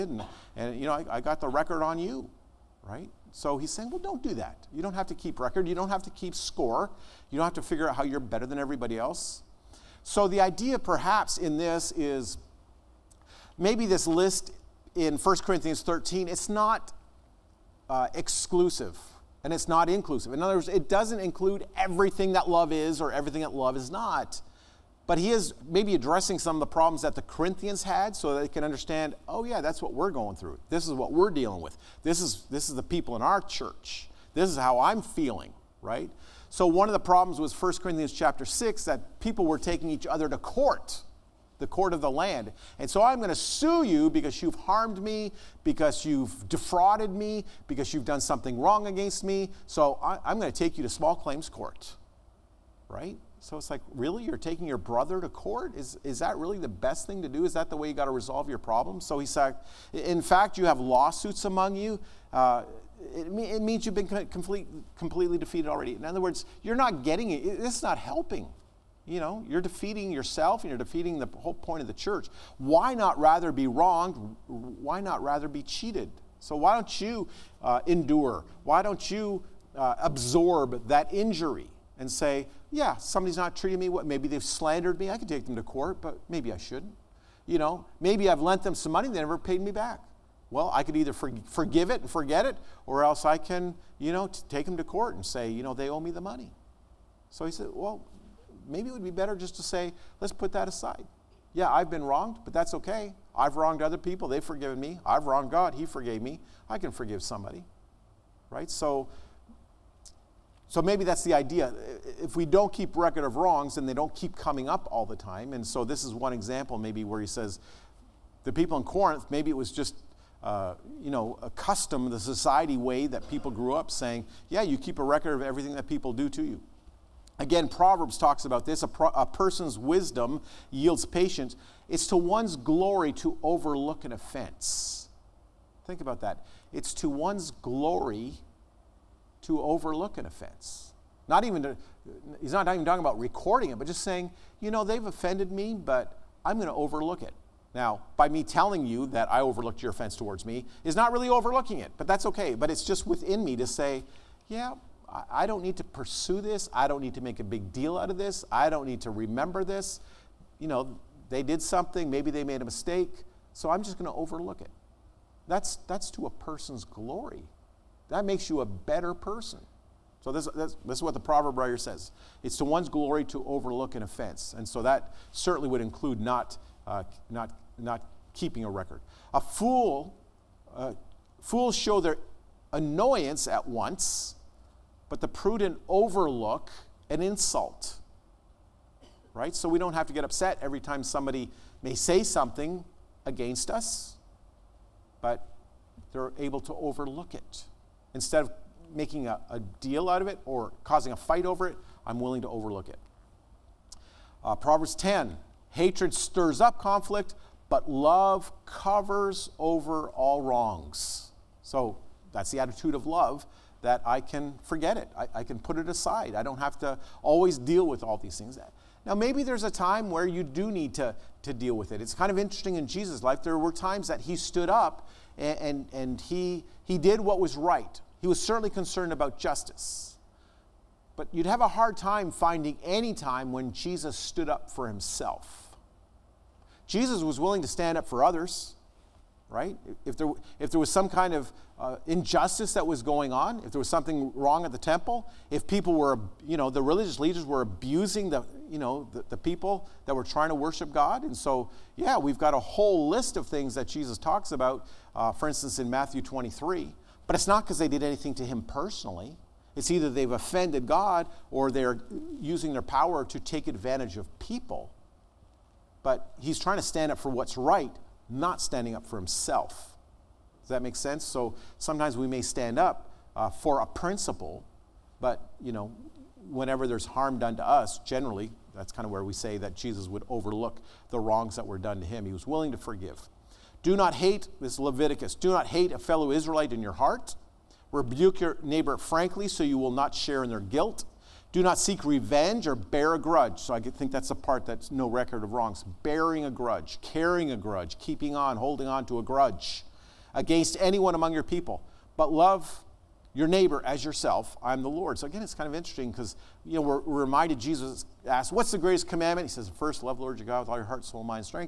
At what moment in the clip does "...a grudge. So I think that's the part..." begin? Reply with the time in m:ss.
4:53.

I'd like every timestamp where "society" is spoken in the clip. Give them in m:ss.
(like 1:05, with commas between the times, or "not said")
2:02.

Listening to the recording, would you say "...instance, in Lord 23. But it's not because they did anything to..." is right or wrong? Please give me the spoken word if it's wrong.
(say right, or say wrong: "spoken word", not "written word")
wrong: "Matthew", not "Lord".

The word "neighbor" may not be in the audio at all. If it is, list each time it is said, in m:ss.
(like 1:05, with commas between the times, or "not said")
4:48, 5:03.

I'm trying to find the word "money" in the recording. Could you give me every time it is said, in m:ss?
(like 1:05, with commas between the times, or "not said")
1:28, 1:36.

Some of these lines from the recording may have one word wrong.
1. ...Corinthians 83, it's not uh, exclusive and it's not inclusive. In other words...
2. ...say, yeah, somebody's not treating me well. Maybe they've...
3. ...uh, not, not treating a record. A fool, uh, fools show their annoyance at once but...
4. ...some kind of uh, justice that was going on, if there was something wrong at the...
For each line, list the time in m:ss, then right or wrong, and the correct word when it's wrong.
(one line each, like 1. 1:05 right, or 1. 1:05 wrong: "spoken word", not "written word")
1. 0:15 wrong: "13", not "83"
2. 1:22 right
3. 2:56 wrong: "keeping", not "treating"
4. 4:00 wrong: "injustice", not "justice".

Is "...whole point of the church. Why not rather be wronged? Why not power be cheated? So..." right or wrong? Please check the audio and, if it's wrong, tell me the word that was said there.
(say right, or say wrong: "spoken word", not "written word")
wrong: "rather", not "power".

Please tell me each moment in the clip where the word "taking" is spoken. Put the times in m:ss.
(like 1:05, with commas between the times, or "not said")
0:39, 0:54.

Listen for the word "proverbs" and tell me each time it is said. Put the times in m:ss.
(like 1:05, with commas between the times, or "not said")
2:07, 2:51, 3:24.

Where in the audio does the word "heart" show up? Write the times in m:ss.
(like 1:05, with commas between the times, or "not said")
4:46, 5:10.